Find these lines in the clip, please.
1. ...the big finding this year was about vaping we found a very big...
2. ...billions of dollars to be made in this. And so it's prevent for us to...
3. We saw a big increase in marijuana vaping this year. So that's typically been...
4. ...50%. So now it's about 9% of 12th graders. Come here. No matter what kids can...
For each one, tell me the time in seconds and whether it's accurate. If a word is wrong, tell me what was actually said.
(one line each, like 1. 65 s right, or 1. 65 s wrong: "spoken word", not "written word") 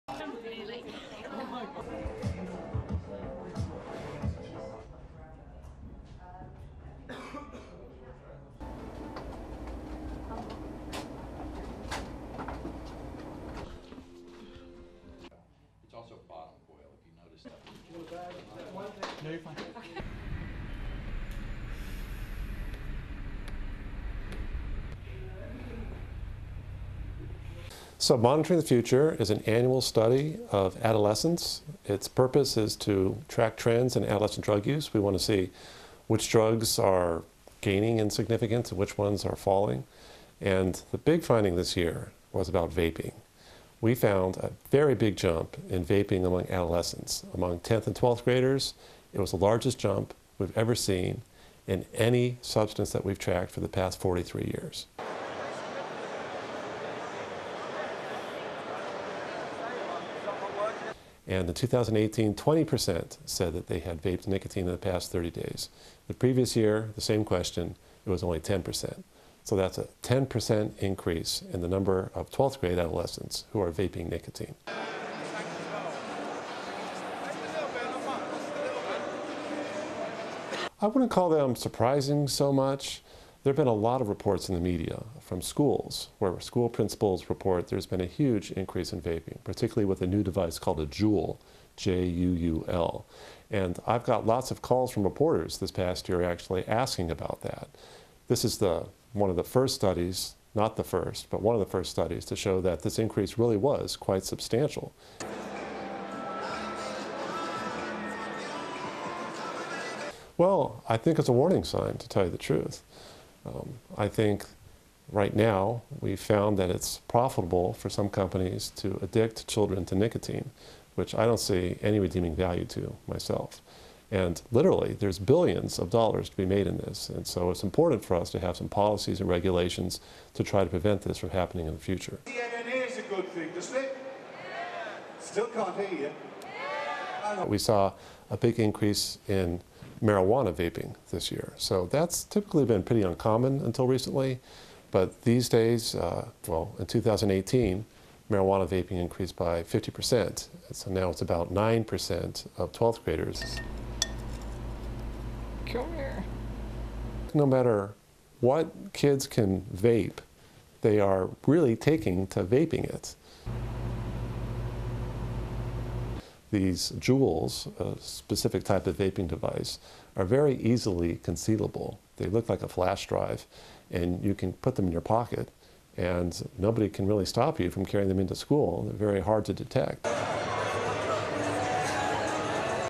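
1. 40 s right
2. 125 s wrong: "important", not "prevent"
3. 137 s right
4. 149 s right.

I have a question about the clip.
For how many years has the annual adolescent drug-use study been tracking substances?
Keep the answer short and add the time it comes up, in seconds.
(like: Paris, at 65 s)
43, at 53 s.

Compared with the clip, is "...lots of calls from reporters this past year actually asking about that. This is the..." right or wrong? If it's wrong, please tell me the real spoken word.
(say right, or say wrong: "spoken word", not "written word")
right.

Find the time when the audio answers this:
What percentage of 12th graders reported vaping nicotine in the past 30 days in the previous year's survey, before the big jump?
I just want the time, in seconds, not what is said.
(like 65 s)
68 s.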